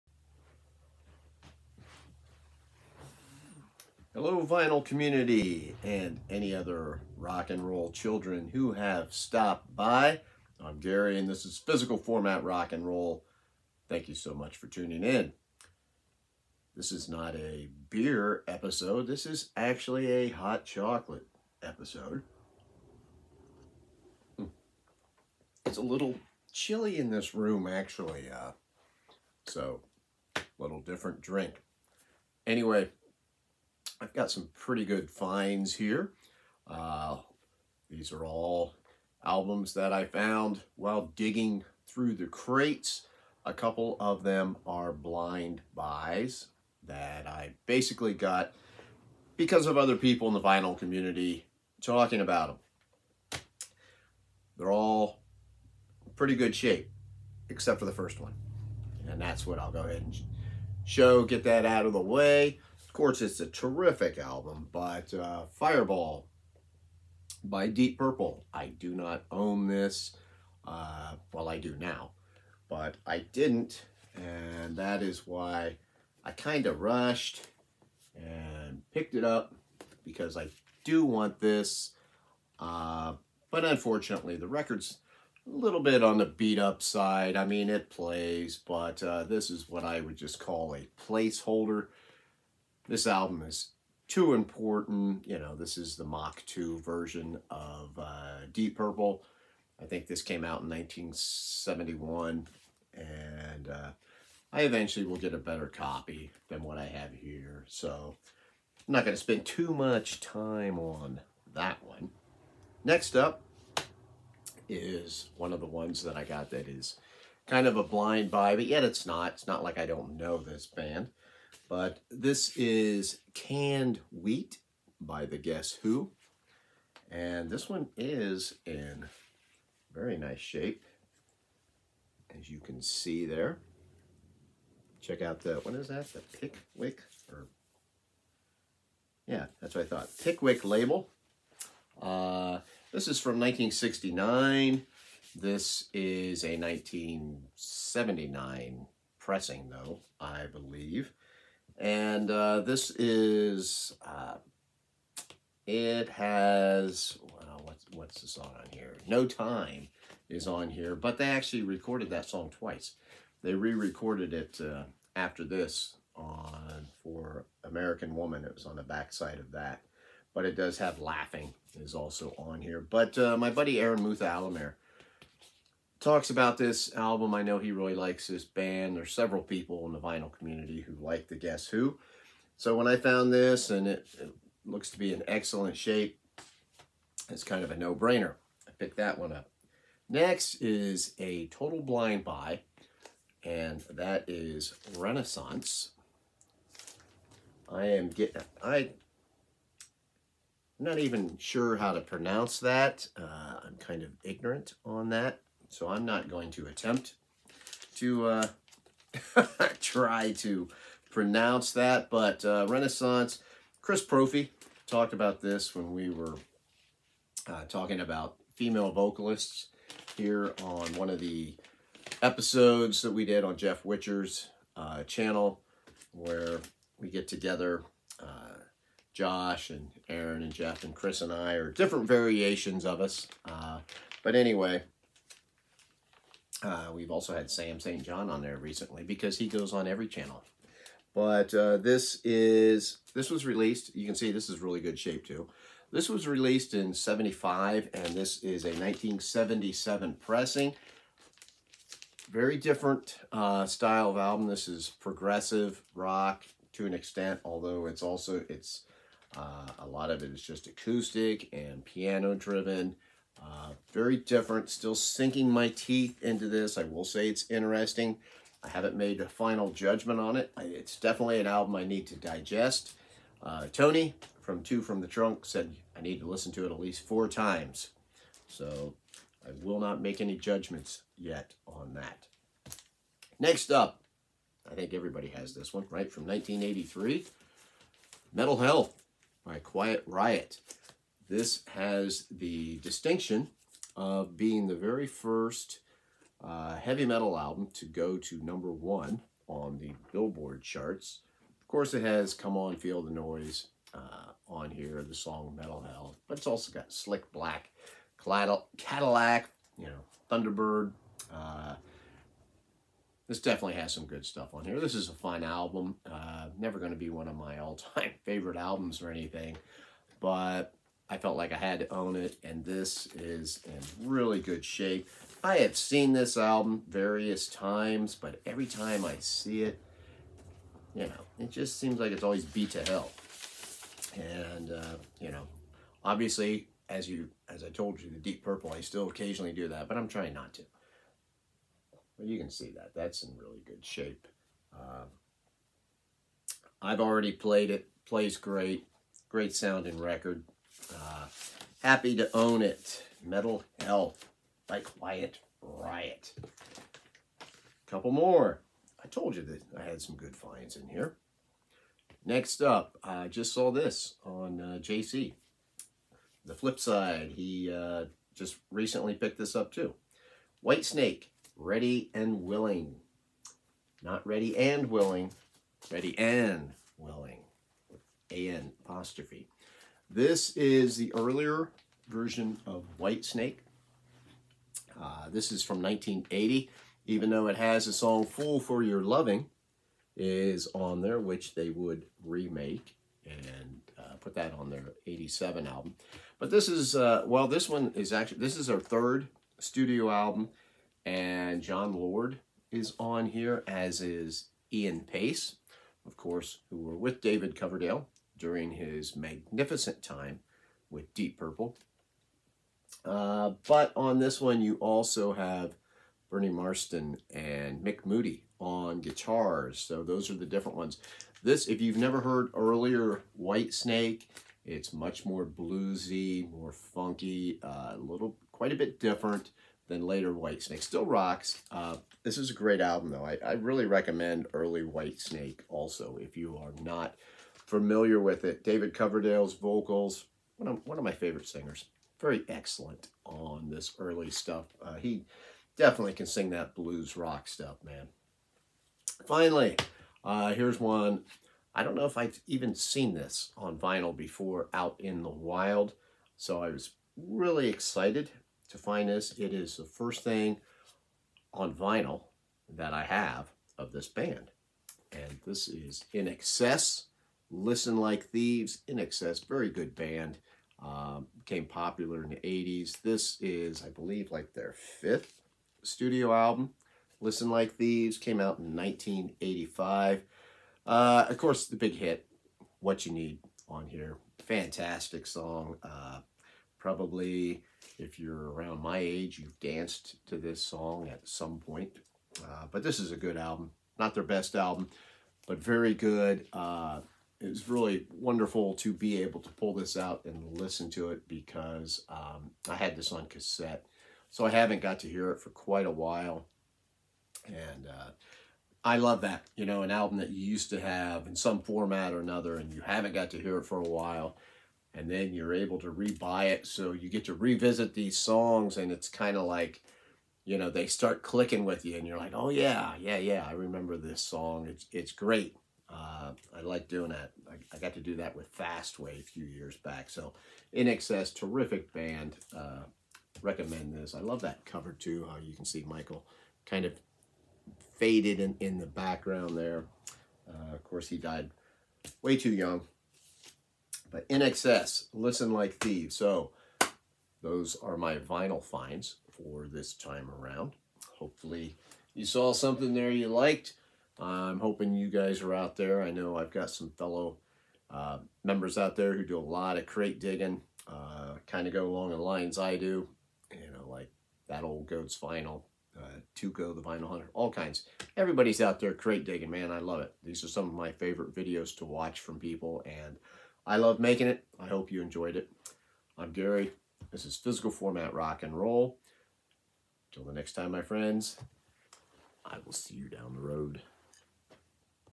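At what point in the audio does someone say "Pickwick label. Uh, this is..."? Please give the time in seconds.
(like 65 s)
140 s.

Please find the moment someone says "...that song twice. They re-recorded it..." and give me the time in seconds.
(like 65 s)
162 s.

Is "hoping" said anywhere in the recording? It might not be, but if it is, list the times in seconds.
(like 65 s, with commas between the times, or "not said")
554 s.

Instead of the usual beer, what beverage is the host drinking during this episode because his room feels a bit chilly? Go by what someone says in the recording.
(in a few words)
Hot chocolate.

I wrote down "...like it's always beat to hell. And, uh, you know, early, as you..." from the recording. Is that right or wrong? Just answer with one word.
wrong.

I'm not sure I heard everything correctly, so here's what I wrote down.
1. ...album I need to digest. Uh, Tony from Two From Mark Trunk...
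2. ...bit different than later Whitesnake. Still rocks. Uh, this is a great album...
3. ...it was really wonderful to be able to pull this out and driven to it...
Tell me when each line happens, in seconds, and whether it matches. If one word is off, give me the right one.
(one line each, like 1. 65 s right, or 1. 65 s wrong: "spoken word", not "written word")
1. 271 s wrong: "The", not "Mark"
2. 428 s right
3. 497 s wrong: "listen", not "driven".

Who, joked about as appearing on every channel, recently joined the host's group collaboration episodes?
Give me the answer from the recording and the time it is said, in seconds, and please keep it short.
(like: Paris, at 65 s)
Sam St. John, at 237 s.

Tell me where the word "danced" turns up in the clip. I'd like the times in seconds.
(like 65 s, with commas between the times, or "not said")
489 s.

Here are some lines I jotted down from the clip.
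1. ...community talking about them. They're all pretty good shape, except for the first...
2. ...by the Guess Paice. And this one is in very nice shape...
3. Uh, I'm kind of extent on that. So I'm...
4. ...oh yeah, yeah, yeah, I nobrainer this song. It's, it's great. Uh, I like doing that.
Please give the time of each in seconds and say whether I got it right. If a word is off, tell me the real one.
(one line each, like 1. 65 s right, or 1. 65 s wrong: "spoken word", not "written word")
1. 50 s right
2. 124 s wrong: "Who", not "Paice"
3. 203 s wrong: "ignorant", not "extent"
4. 522 s wrong: "remember", not "nobrainer".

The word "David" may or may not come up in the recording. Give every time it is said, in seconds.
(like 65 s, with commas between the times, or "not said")
407 s, 438 s.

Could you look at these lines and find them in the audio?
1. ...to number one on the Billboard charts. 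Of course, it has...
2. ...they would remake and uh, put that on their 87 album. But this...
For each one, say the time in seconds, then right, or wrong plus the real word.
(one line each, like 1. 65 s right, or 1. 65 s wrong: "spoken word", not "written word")
1. 298 s right
2. 391 s right.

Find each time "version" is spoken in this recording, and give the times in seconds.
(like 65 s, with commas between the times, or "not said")
96 s, 382 s.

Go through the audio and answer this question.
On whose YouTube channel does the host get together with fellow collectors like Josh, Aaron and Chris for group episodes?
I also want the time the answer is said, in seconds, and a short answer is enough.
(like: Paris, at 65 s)
Jeff Witcher, at 223 s.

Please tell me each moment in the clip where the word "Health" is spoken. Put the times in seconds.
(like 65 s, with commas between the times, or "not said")
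288 s, 305 s, 353 s.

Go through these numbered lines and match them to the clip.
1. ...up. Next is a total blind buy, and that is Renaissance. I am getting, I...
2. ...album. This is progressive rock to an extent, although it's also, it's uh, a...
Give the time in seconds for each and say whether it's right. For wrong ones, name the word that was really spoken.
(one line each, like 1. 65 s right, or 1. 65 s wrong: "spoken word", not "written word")
1. 189 s right
2. 254 s right.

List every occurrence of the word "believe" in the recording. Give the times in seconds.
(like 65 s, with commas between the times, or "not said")
150 s, 473 s.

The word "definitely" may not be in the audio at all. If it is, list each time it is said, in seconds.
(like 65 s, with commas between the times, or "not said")
270 s, 313 s, 445 s.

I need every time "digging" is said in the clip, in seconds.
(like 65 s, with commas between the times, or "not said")
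41 s, 560 s, 569 s.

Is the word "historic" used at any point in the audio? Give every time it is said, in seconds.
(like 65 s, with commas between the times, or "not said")
not said.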